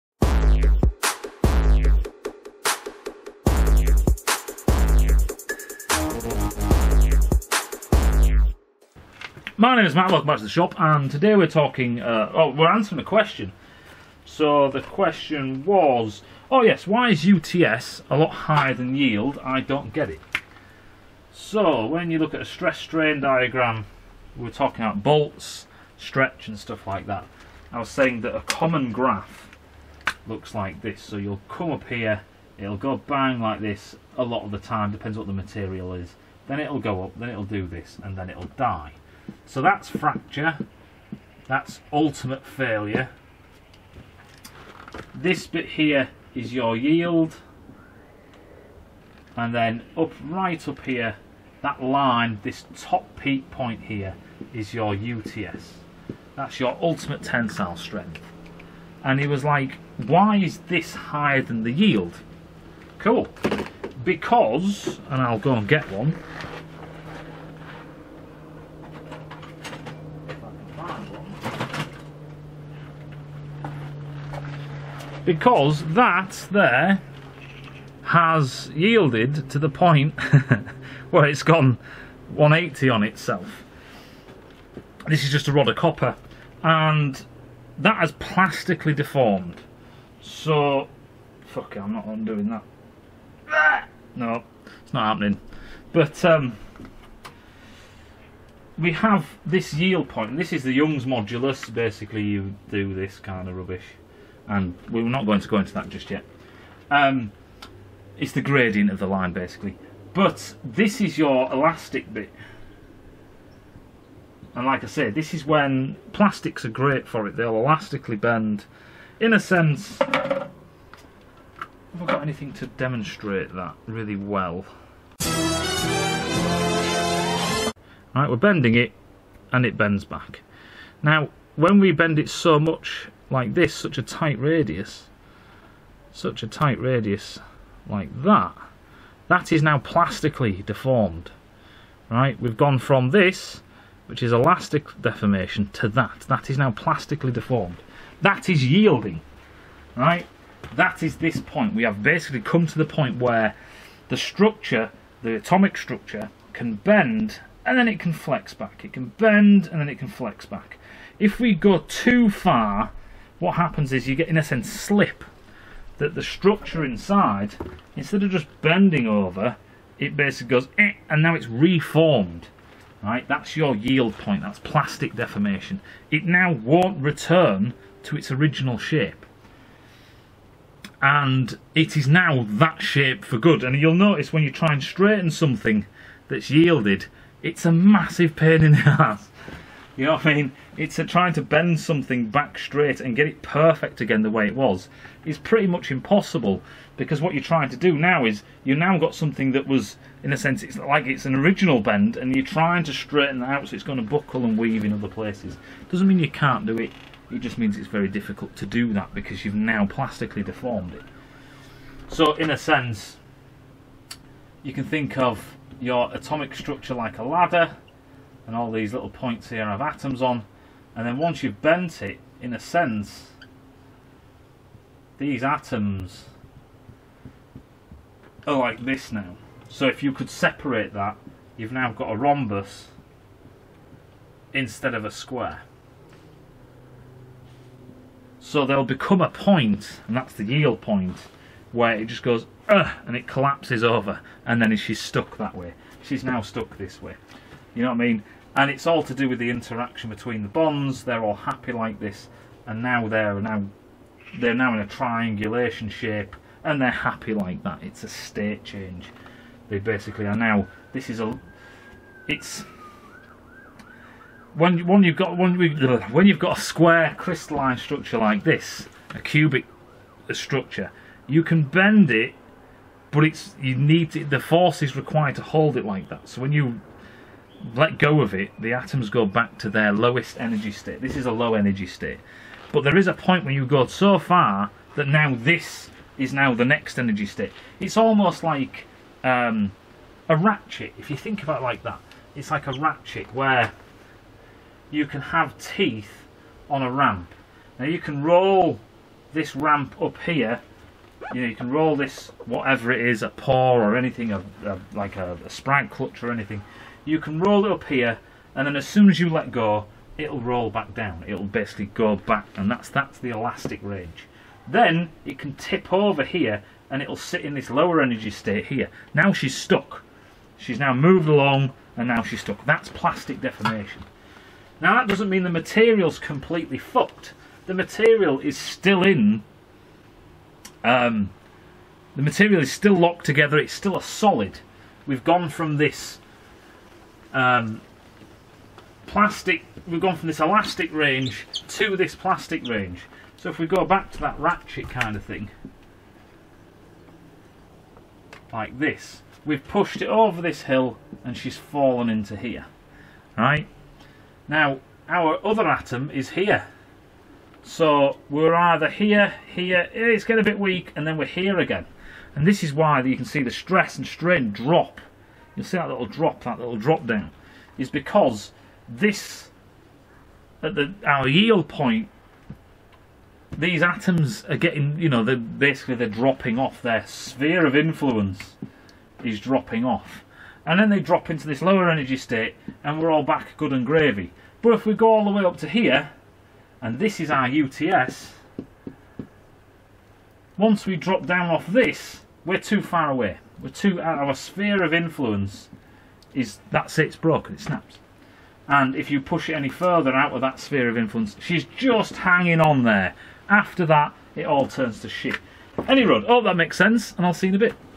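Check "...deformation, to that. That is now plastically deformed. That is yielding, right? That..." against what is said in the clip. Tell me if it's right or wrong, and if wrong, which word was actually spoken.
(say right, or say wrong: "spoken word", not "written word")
right.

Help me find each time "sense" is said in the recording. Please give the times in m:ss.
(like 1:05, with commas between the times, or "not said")
1:59, 2:44, 3:20, 3:32, 3:42, 6:46.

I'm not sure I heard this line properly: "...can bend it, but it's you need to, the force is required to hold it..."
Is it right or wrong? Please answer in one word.
right.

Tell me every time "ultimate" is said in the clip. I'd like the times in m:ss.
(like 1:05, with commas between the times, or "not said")
0:41, 0:56.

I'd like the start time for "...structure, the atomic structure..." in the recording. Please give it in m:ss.
2:34.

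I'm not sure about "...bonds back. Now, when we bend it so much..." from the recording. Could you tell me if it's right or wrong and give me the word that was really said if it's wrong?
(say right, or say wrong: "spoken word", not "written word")
wrong: "bends", not "bonds".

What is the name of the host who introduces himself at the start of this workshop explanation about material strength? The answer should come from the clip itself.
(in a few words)
Matt.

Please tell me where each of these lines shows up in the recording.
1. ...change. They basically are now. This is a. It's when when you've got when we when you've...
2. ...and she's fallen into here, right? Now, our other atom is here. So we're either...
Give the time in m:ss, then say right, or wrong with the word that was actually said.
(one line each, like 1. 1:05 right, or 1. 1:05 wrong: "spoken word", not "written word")
1. 4:18 right
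2. 5:51 right.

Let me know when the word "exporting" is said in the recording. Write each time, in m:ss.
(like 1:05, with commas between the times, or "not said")
not said.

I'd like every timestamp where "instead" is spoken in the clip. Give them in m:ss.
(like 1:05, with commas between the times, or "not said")
2:47, 3:54.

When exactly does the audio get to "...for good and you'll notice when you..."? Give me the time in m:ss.
3:03.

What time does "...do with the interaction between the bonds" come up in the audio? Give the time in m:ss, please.
4:09.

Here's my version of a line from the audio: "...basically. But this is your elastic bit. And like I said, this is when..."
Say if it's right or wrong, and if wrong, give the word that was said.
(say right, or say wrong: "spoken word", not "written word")
right.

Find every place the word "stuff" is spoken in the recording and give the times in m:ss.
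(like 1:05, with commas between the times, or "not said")
0:26.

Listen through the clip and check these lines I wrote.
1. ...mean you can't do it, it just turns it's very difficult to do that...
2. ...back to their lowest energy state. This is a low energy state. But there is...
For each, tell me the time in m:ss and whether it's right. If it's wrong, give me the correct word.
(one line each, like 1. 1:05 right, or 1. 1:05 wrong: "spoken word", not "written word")
1. 3:26 wrong: "means", not "turns"
2. 4:39 right.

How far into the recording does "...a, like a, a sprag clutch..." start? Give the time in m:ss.
5:04.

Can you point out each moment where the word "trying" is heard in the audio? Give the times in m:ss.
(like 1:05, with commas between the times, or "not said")
3:11, 3:17, 3:22.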